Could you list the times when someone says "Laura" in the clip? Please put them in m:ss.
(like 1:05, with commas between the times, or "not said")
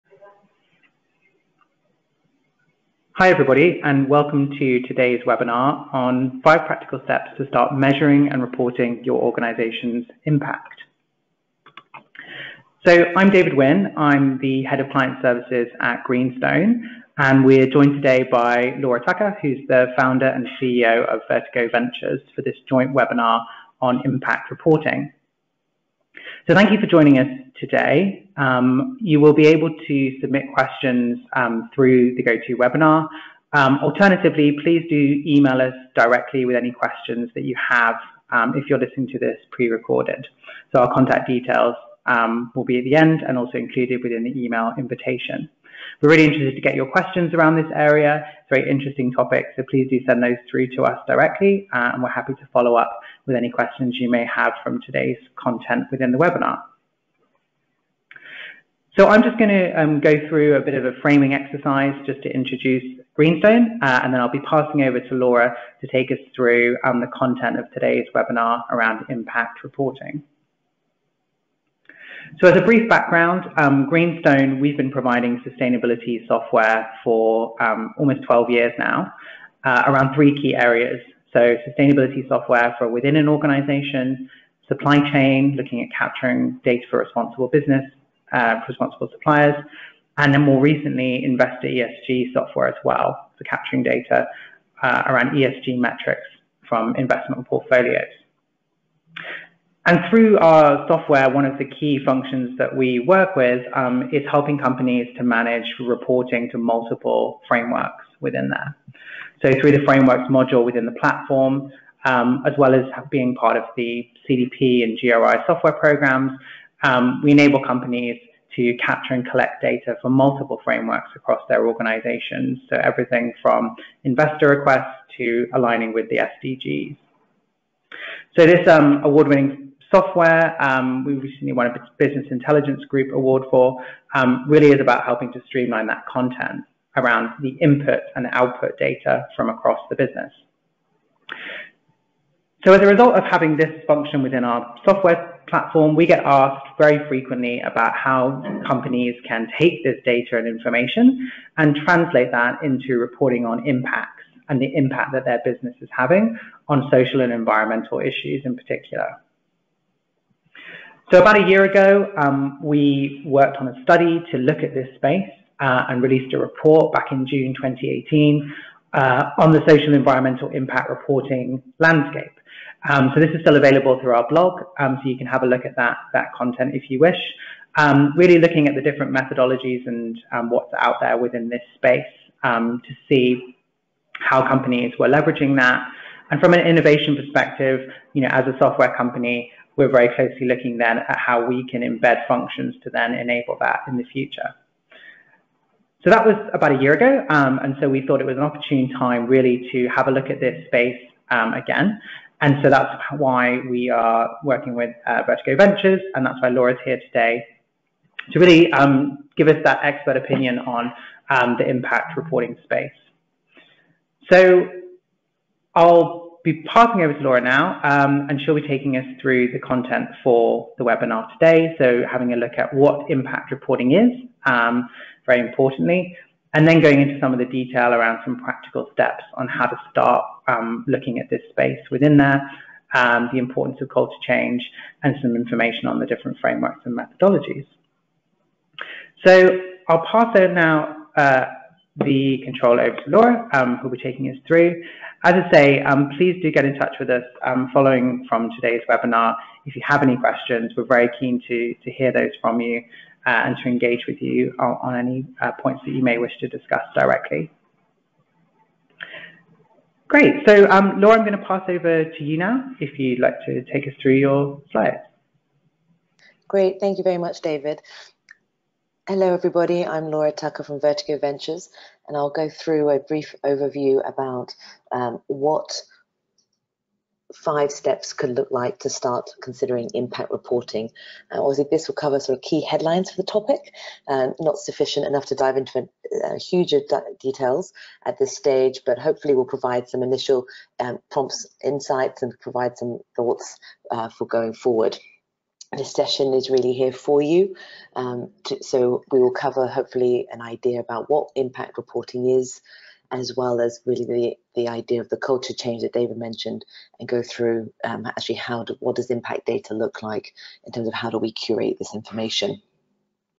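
0:18, 1:05, 3:26, 3:37, 4:03, 4:20, 4:30.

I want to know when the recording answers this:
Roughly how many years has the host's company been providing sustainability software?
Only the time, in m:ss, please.
1:18.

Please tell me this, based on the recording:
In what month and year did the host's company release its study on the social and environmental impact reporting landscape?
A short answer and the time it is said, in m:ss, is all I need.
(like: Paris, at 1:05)
June 2018, at 2:47.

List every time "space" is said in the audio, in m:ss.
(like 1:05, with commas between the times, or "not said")
2:44, 3:01, 3:20, 3:32, 3:51.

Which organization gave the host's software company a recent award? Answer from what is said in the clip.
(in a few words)
Business Intelligence Group.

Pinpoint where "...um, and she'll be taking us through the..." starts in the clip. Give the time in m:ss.
3:37.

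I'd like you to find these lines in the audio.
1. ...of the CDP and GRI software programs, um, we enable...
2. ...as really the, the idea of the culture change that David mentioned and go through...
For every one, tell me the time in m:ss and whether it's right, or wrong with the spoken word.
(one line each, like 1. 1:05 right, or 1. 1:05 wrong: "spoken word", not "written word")
1. 1:53 right
2. 5:03 right.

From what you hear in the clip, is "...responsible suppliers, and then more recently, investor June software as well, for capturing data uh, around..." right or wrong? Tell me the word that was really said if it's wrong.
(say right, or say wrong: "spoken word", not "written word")
wrong: "ESG", not "June".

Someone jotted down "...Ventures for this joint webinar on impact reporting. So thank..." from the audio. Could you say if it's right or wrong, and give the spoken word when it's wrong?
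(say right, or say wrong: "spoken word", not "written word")
right.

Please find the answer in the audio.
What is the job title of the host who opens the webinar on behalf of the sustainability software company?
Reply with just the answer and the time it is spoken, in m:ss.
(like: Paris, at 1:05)
Head of Client Services, at 0:14.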